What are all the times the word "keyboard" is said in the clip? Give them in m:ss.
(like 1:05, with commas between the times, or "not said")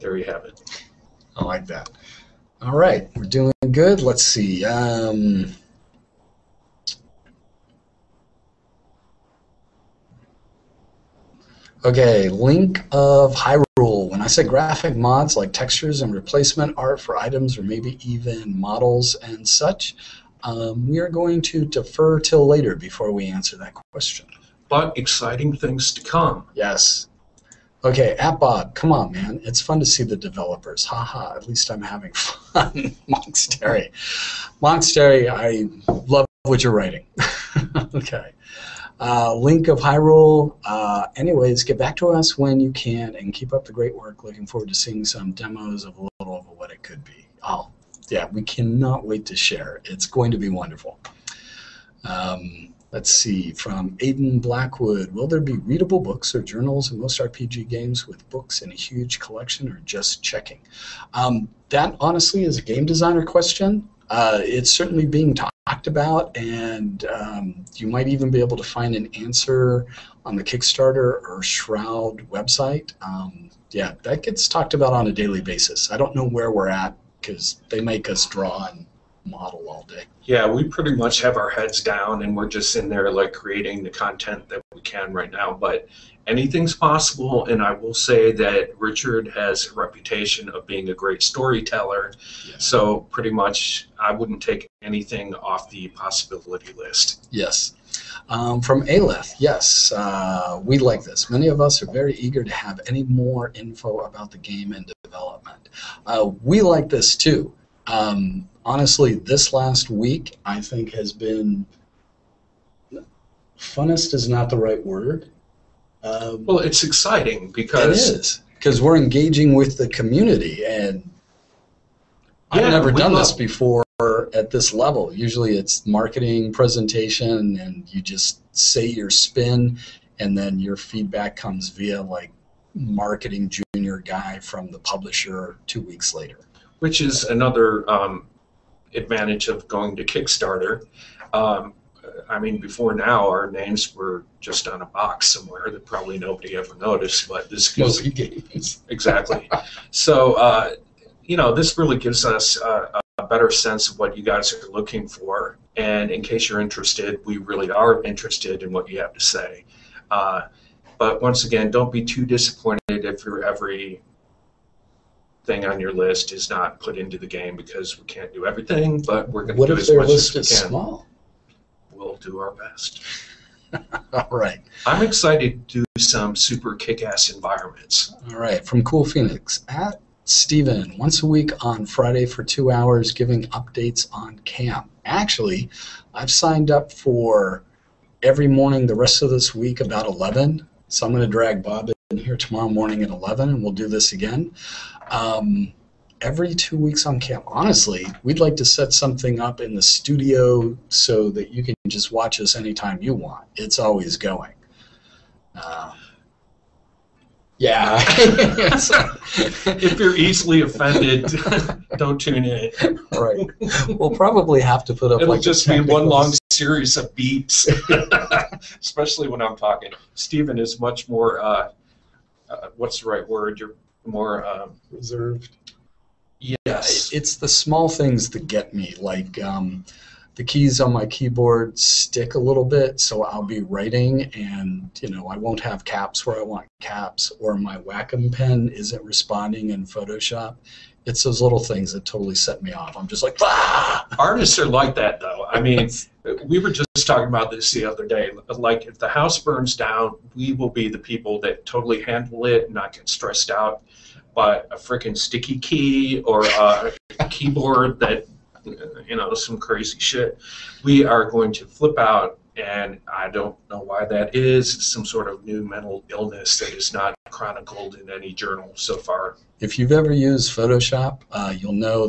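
3:51, 4:17.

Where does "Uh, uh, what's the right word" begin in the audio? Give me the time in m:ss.
3:41.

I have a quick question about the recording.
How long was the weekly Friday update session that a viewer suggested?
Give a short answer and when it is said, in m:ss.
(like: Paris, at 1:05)
2 hours, at 3:02.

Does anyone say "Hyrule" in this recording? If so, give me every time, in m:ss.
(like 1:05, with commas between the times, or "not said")
0:13, 0:39.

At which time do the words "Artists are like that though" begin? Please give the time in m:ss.
4:04.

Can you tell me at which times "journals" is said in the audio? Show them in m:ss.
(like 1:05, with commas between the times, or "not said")
0:56, 4:28.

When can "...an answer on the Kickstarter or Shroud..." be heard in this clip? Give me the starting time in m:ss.
1:08.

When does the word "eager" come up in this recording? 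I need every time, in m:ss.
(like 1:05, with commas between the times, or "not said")
1:42.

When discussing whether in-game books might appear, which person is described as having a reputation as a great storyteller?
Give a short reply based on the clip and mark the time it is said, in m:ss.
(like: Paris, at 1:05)
Richard, at 1:28.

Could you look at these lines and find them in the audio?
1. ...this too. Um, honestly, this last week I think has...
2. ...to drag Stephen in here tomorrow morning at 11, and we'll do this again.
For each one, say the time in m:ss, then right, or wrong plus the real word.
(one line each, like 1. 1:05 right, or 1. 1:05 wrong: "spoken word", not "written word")
1. 1:46 right
2. 3:11 wrong: "Bob", not "Stephen".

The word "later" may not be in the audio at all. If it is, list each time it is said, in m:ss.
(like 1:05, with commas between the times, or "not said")
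0:22, 2:16.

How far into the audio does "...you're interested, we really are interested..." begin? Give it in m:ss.
2:36.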